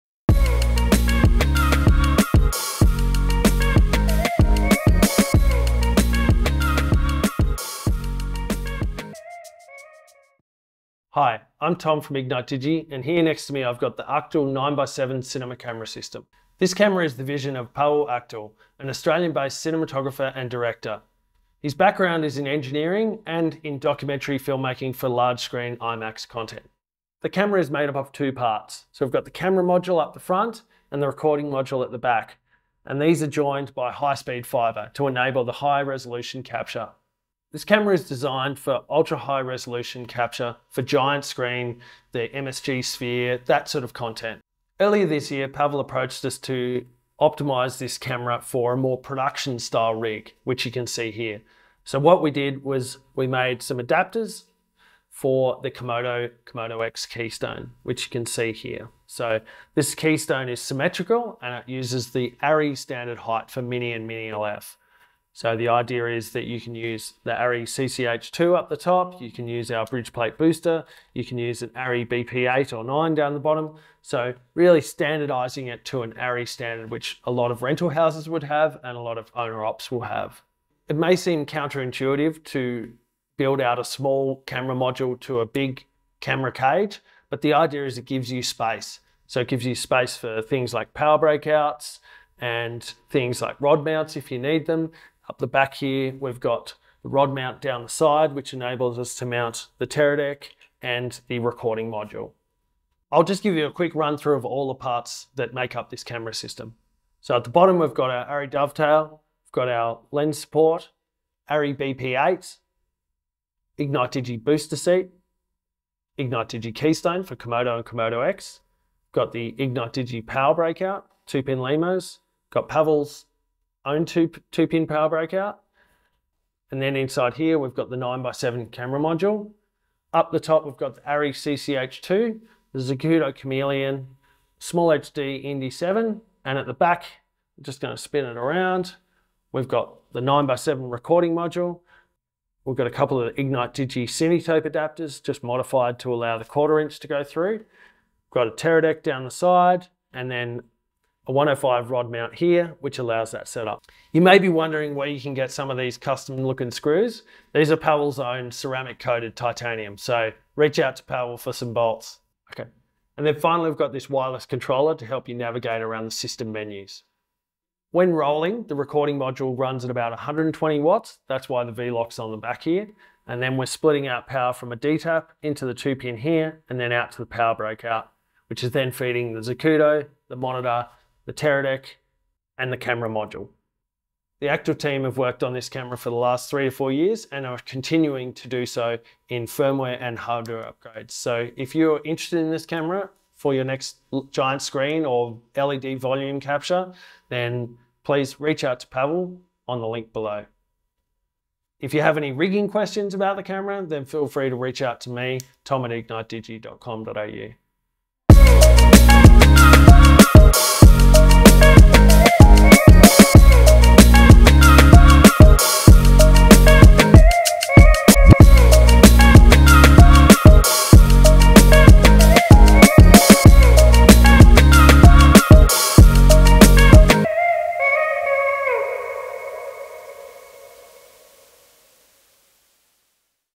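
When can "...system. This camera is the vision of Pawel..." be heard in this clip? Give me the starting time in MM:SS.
00:15.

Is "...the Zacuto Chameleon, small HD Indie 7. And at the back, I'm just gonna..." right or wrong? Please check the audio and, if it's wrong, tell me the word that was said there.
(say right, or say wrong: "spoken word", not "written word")
right.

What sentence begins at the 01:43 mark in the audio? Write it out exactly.
I'll just give you a quick run through of all the parts that make up this camera system.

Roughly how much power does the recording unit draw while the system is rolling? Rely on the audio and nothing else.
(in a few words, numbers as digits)
120 watts.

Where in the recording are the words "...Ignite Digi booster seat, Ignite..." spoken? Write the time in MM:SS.
01:53.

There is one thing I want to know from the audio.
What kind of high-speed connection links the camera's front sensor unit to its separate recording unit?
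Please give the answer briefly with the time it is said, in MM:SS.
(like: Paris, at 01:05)
Fibre, at 00:33.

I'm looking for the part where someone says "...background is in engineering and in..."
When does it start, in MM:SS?
00:21.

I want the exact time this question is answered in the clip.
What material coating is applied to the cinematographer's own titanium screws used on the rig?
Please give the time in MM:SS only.
02:38.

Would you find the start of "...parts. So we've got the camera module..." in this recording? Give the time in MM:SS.
00:28.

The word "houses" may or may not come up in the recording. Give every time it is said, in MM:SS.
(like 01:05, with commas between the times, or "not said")
01:17.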